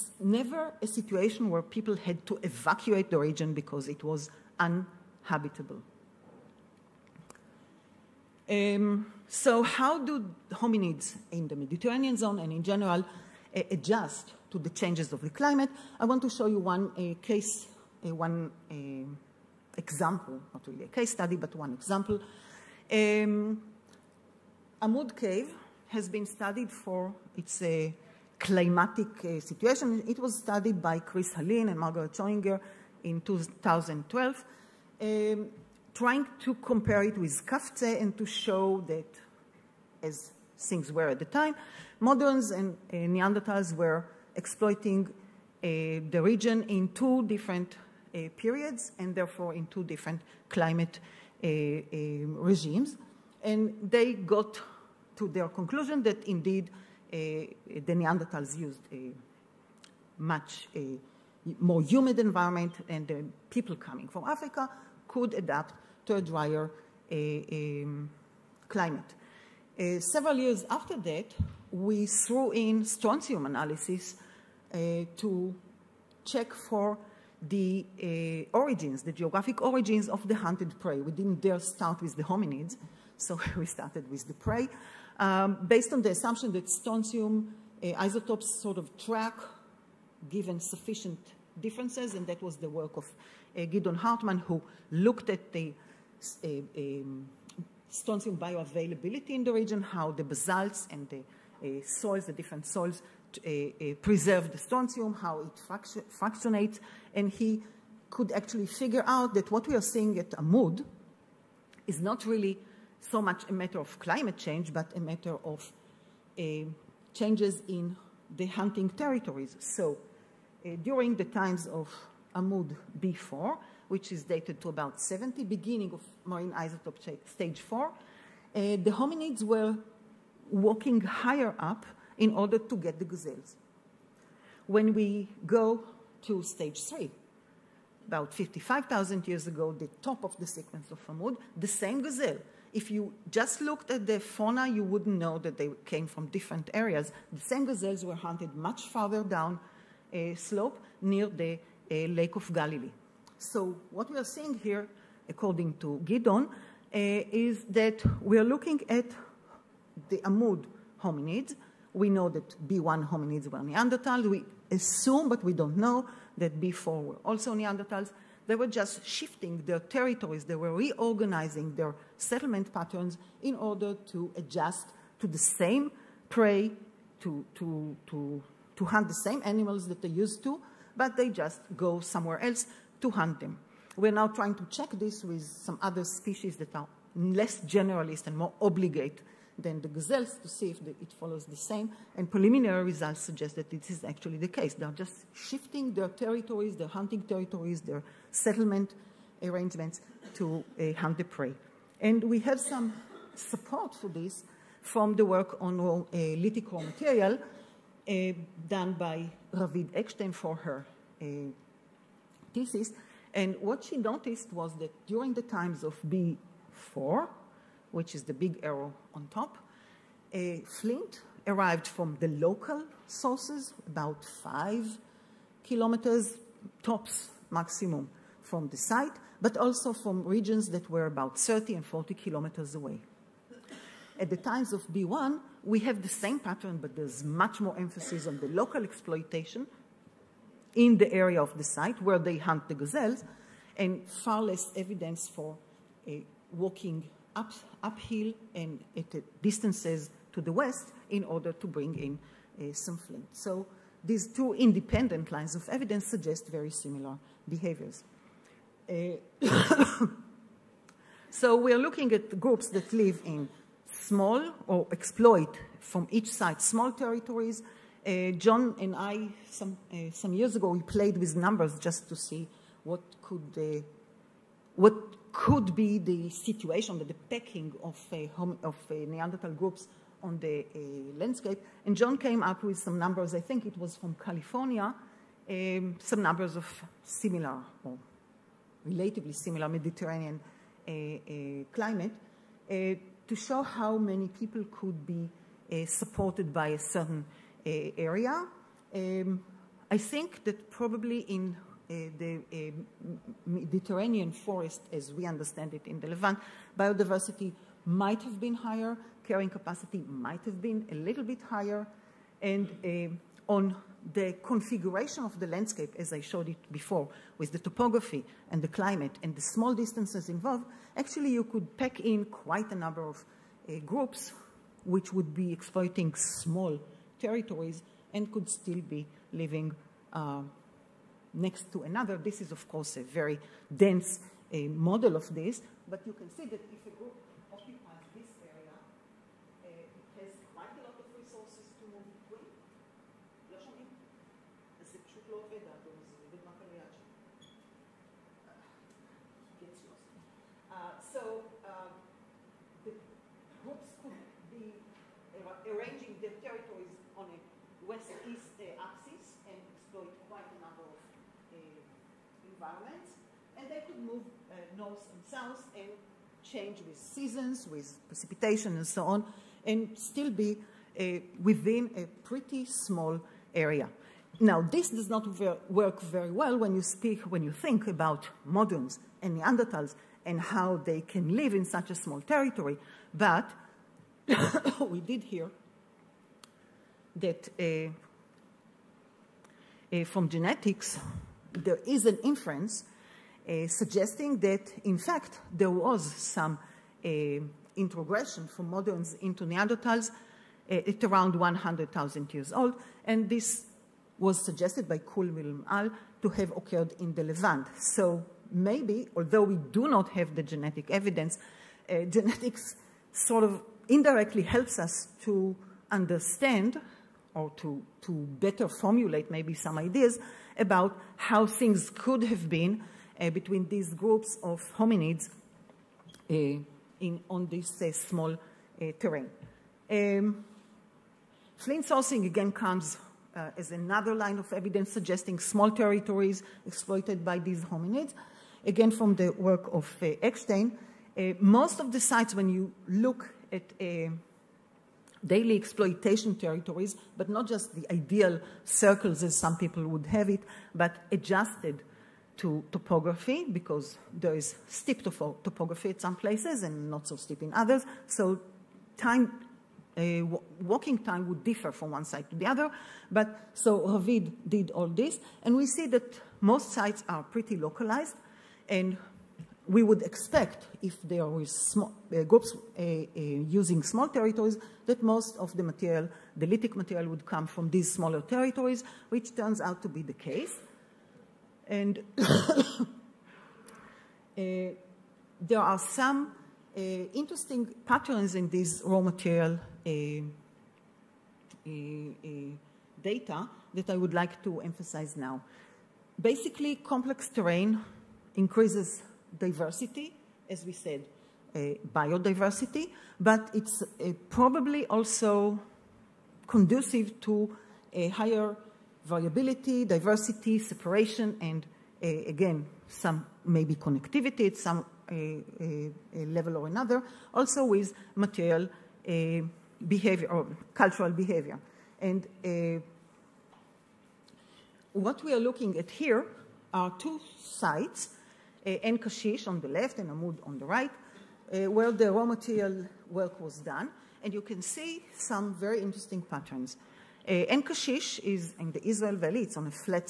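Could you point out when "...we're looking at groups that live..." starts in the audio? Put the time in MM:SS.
04:21.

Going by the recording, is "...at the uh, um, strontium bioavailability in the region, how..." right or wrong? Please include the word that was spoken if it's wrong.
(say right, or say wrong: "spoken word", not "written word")
right.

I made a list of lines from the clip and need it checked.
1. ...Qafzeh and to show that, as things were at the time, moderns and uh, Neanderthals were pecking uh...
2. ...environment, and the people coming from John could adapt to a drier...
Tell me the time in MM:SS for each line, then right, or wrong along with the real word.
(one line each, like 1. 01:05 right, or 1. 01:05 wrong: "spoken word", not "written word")
1. 00:37 wrong: "exploiting", not "pecking"
2. 01:02 wrong: "Africa", not "John".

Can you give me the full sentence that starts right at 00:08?
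Um, so how do hominids in the Mediterranean zone and in general uh, adjust to the changes of the climate?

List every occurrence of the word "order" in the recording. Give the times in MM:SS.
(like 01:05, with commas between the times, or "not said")
02:12, 02:53, 04:11.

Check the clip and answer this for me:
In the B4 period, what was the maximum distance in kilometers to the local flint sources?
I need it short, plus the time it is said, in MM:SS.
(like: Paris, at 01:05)
5, at 03:44.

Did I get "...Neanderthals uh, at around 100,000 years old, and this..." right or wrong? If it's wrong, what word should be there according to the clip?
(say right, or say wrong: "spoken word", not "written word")
right.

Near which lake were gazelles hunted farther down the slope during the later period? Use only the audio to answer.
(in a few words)
Lake of Galilee.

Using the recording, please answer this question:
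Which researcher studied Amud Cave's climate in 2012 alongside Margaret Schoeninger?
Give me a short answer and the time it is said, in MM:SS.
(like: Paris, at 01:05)
Chris Hallin, at 00:30.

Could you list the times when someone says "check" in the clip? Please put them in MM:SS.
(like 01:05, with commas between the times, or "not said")
01:16, 03:04.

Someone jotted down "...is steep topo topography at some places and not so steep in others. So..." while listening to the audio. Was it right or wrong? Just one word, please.
right.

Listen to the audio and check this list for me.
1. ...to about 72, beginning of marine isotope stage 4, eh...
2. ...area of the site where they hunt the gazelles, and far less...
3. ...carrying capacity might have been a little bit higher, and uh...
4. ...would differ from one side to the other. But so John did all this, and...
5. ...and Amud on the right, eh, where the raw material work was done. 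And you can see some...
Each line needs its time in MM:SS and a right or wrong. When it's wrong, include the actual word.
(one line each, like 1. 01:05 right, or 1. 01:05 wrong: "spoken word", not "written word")
1. 02:04 wrong: "70", not "72"
2. 04:01 right
3. 05:09 right
4. 07:41 wrong: "Ravid", not "John"
5. 08:49 right.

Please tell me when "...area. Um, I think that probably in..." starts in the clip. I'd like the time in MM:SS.
04:57.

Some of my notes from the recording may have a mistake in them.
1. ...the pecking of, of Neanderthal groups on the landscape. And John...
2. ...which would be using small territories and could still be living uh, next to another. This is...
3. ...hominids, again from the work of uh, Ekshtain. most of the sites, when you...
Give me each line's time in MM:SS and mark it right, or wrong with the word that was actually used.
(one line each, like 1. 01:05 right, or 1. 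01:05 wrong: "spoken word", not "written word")
1. 04:37 right
2. 05:24 wrong: "exploiting", not "using"
3. 07:17 right.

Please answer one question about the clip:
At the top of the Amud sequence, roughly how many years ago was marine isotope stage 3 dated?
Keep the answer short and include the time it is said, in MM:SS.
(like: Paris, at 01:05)
55,000, at 02:18.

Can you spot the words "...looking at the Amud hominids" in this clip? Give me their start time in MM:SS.
02:38.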